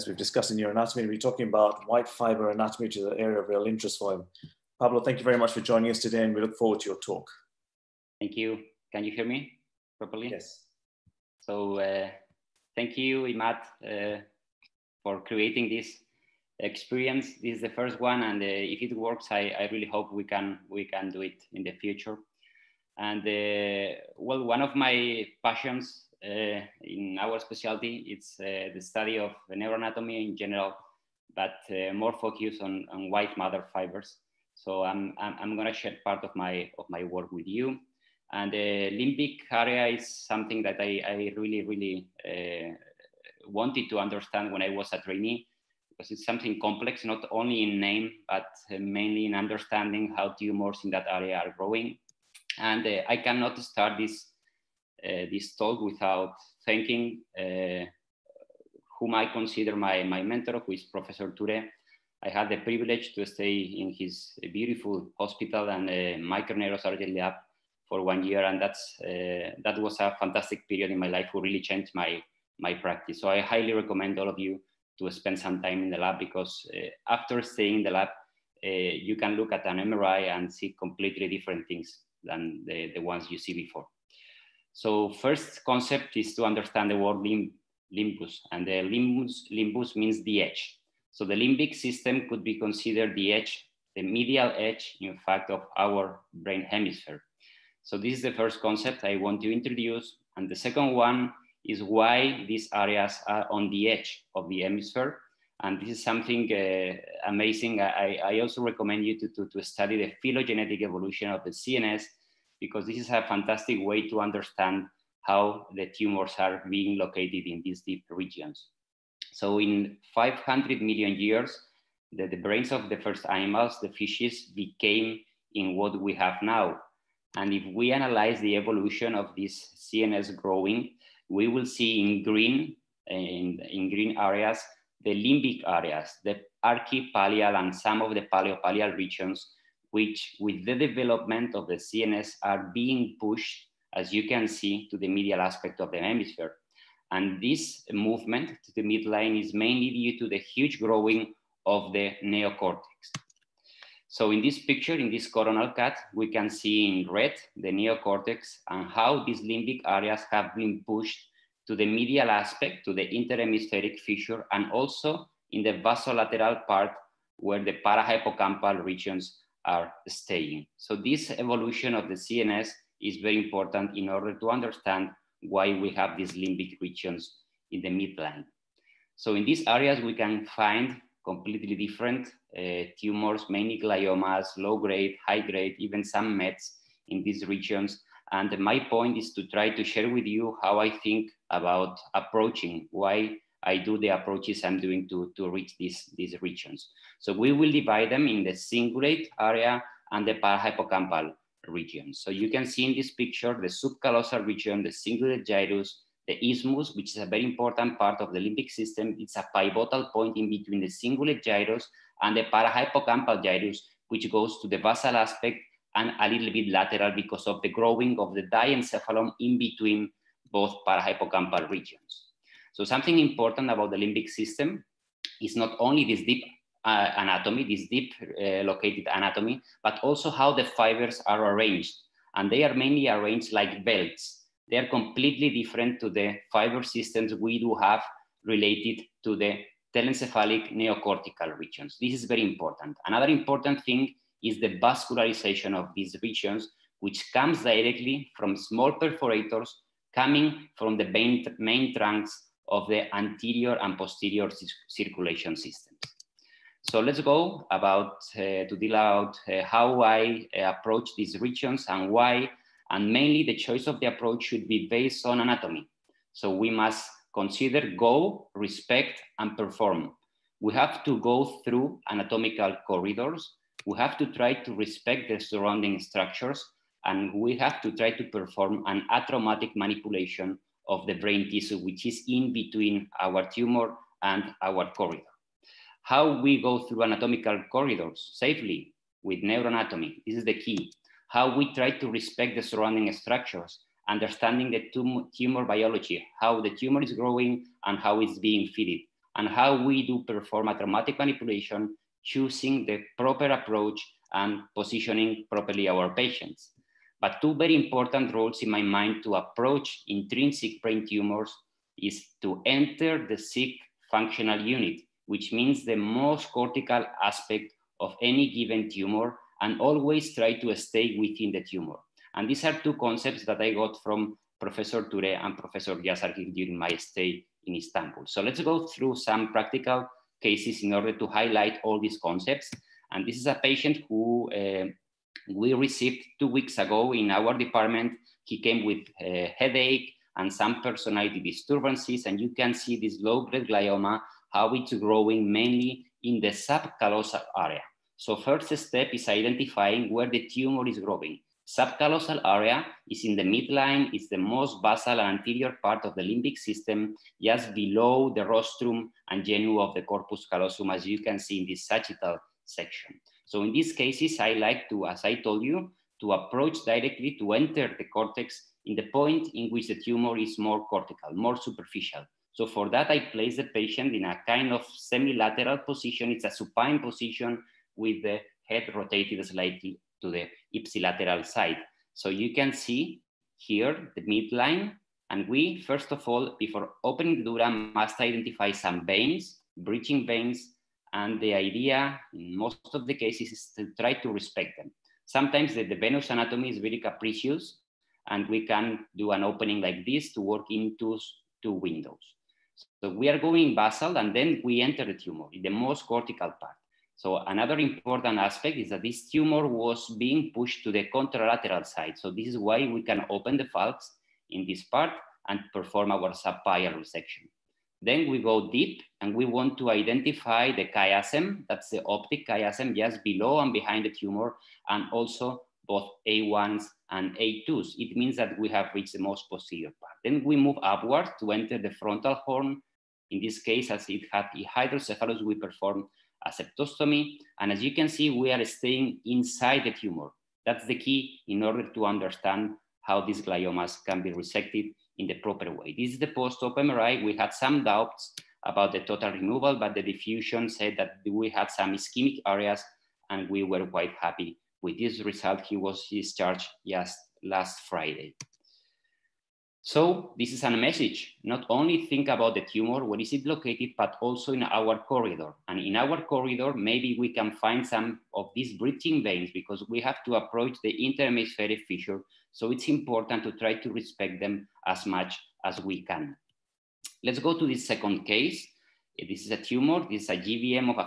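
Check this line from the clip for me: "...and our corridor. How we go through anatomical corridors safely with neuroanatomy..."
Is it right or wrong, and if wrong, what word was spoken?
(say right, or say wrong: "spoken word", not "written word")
right.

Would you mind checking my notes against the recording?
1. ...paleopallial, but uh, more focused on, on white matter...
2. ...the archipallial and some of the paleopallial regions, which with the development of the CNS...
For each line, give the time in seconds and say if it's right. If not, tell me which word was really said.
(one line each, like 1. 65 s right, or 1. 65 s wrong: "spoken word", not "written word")
1. 30 s wrong: "general", not "paleopallial"
2. 136 s right.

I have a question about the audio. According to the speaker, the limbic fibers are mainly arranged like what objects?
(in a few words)
belts.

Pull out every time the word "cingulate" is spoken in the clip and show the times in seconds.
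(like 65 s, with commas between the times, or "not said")
198 s, 204 s, 210 s.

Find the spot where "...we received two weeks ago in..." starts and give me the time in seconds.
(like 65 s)
335 s.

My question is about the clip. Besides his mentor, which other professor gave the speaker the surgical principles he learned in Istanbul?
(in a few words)
Professor Yasargil.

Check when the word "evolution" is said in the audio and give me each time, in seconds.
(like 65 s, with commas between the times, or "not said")
110 s, 128 s, 171 s.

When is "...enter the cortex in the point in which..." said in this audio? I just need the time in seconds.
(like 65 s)
367 s.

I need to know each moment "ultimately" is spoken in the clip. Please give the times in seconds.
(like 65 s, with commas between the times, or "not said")
not said.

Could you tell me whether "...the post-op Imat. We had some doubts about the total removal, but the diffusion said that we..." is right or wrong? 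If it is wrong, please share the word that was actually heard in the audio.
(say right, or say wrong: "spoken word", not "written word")
wrong: "MRI", not "Imat".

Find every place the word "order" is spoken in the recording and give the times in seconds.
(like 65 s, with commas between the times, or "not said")
174 s, 330 s, 441 s.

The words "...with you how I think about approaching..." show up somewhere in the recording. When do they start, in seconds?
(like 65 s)
190 s.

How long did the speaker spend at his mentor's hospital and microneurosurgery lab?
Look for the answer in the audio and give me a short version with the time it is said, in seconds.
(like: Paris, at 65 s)
1 year, at 68 s.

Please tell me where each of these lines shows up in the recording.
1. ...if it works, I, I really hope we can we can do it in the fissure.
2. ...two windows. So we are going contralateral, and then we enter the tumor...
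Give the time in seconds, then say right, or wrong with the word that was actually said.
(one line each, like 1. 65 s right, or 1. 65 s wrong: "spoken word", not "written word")
1. 18 s wrong: "future", not "fissure"
2. 401 s wrong: "basal", not "contralateral".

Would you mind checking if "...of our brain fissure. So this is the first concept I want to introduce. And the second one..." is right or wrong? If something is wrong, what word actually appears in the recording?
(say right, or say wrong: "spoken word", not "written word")
wrong: "hemisphere", not "fissure".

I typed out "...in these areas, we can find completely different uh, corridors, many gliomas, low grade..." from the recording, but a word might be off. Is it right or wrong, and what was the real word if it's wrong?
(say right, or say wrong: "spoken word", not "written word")
wrong: "tumors", not "corridors".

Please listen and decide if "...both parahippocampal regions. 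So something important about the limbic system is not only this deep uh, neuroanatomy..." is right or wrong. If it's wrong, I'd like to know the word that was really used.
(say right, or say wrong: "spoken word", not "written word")
wrong: "anatomy", not "neuroanatomy".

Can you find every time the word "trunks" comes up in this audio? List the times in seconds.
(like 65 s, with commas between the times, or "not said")
251 s.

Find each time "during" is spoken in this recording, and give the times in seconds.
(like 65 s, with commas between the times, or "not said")
326 s.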